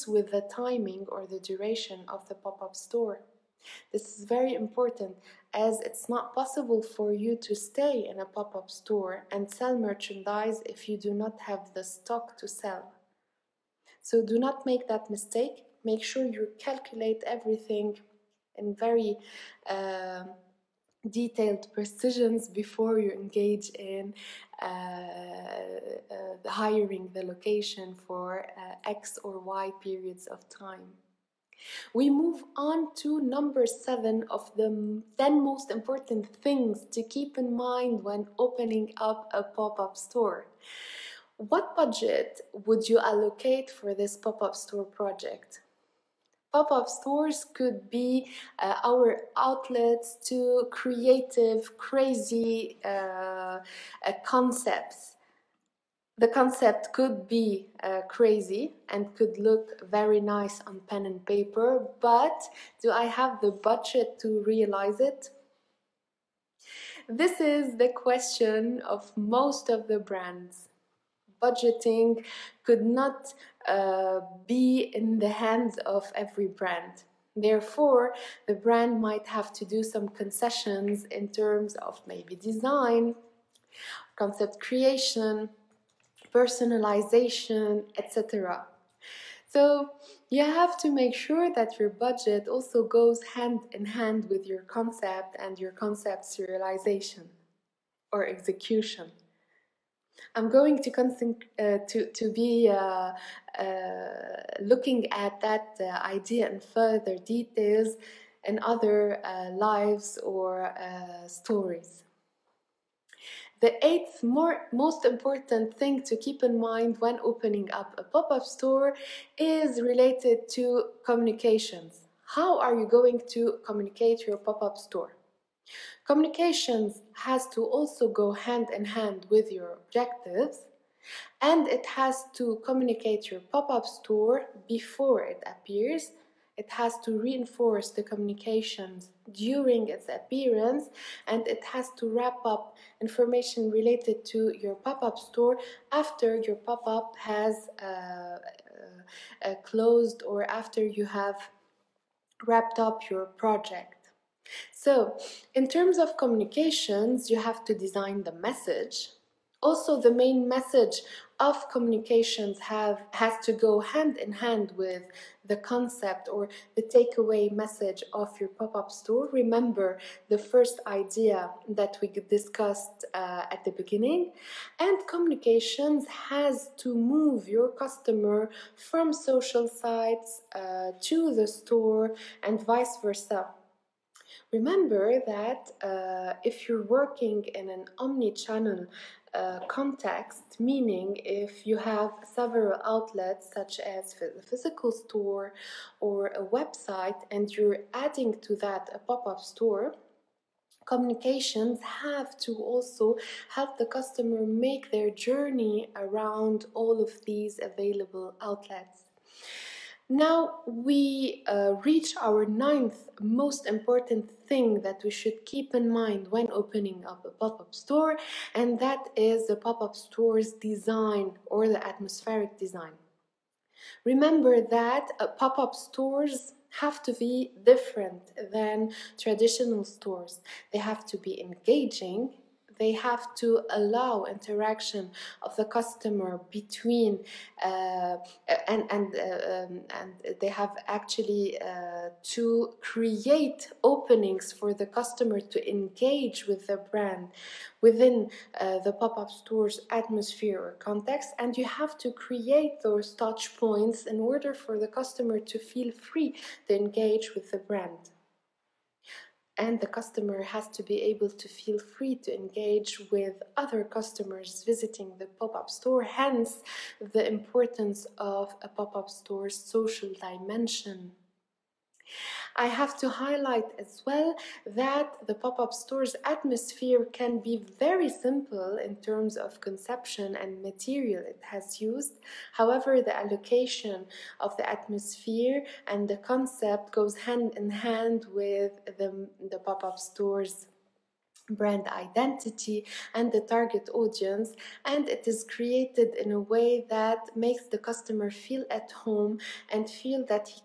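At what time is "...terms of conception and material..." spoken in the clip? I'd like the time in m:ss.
4:38.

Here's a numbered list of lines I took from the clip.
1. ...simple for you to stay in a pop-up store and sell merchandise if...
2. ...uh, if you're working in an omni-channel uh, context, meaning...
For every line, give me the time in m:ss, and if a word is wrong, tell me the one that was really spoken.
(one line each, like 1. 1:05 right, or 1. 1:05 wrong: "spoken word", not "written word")
1. 0:06 wrong: "possible", not "simple"
2. 3:05 right.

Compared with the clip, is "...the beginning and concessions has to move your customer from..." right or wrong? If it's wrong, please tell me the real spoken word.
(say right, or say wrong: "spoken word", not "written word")
wrong: "communications", not "concessions".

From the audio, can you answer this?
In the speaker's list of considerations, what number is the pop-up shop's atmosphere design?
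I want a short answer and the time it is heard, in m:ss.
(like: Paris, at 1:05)
9, at 3:32.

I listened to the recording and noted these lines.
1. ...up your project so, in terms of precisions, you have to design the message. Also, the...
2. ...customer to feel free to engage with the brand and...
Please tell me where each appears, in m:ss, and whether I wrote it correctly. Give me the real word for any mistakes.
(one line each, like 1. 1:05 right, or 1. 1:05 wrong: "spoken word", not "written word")
1. 2:32 wrong: "communications", not "precisions"
2. 4:14 right.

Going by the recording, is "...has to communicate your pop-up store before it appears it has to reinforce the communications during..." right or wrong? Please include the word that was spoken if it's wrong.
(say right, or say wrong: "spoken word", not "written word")
right.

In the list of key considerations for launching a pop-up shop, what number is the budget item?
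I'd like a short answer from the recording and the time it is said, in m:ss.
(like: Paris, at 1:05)
7, at 0:33.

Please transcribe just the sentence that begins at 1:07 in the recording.
This is the question of most of the brands budgeting could not uh, be in the hands of every brand.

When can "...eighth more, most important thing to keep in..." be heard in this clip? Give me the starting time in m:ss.
1:53.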